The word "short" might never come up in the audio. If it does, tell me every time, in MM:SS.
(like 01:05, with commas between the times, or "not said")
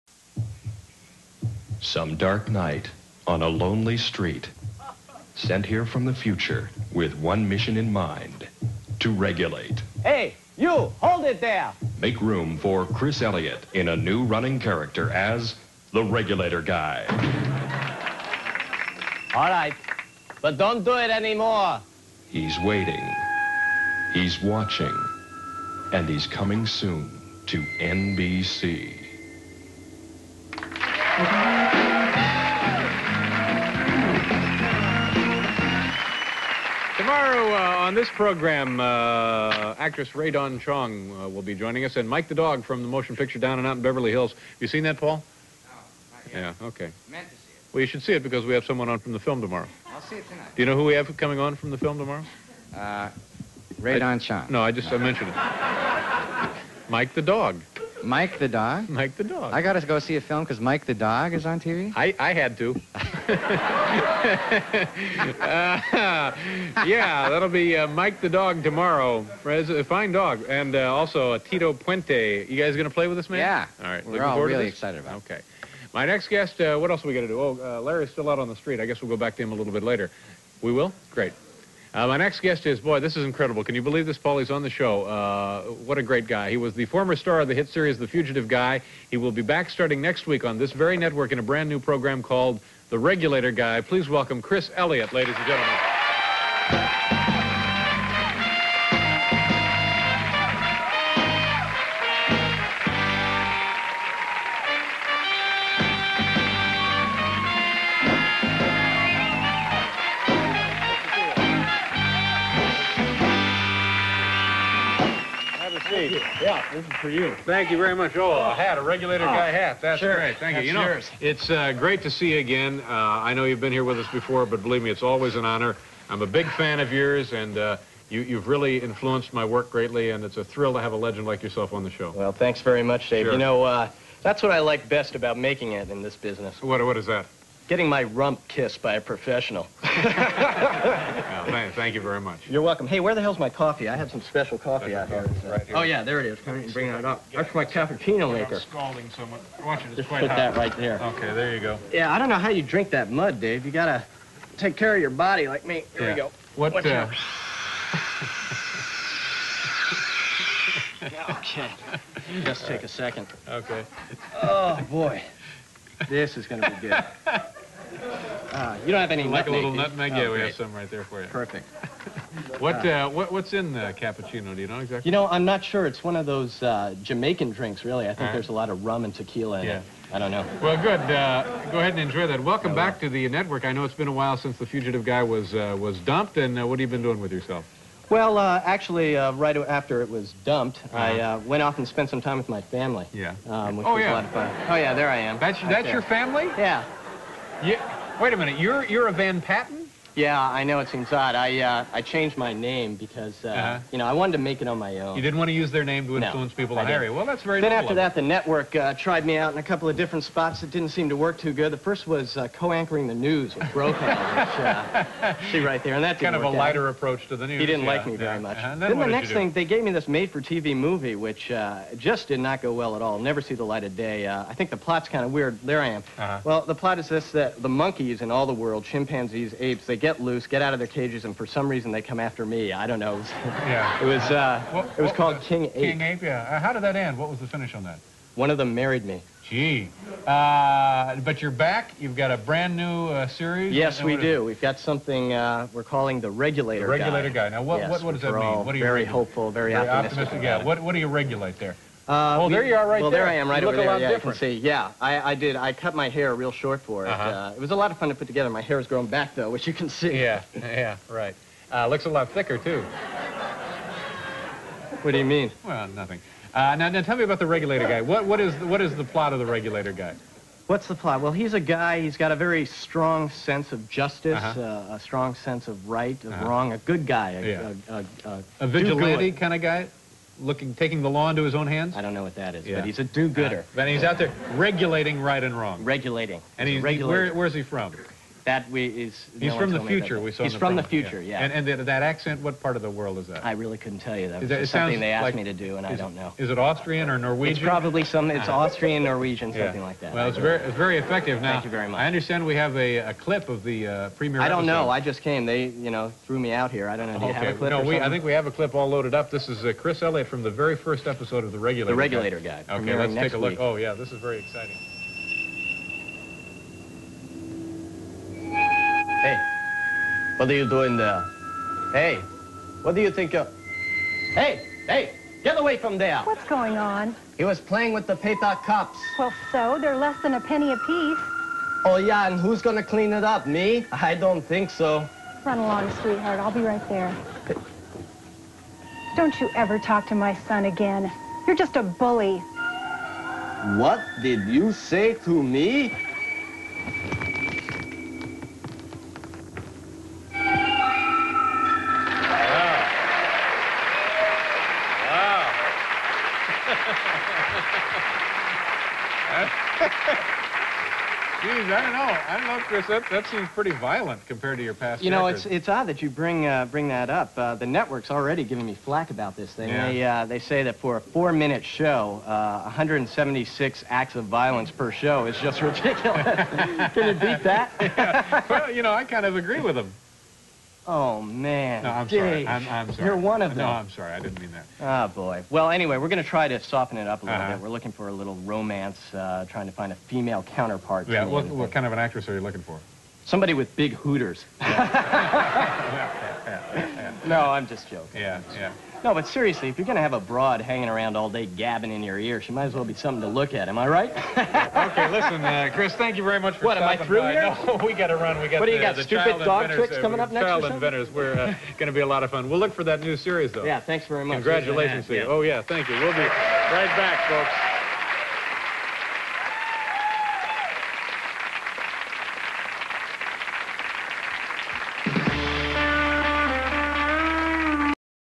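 04:16.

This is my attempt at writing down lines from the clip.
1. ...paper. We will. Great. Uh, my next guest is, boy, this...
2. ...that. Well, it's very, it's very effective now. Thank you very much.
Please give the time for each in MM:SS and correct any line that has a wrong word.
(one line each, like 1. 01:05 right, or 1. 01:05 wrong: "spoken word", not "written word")
1. 01:19 wrong: "later", not "paper"
2. 04:59 right.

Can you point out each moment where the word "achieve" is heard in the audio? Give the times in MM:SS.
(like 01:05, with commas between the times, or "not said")
not said.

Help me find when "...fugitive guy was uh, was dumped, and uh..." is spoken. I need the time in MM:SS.
03:04.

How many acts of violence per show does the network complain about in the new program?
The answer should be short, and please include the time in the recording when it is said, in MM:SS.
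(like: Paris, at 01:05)
176, at 06:12.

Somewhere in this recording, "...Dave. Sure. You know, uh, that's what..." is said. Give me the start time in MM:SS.
02:13.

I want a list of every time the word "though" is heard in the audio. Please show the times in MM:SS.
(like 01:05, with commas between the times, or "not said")
04:19, 06:53.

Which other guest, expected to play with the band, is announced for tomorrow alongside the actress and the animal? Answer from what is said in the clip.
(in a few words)
Tito Puente.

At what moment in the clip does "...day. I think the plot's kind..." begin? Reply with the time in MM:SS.
03:43.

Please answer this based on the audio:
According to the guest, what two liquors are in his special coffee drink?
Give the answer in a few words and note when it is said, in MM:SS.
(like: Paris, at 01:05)
rum and tequila, at 02:58.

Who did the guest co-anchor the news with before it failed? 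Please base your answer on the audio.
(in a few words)
Brokaw.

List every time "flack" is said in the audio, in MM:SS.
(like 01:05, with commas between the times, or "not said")
06:08.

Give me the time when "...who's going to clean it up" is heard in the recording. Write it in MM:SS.
05:32.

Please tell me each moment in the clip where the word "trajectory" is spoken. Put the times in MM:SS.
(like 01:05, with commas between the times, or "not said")
not said.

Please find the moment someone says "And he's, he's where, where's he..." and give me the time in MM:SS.
04:46.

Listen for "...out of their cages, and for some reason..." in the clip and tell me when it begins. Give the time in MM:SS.
03:50.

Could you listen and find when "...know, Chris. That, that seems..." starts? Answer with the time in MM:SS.
06:02.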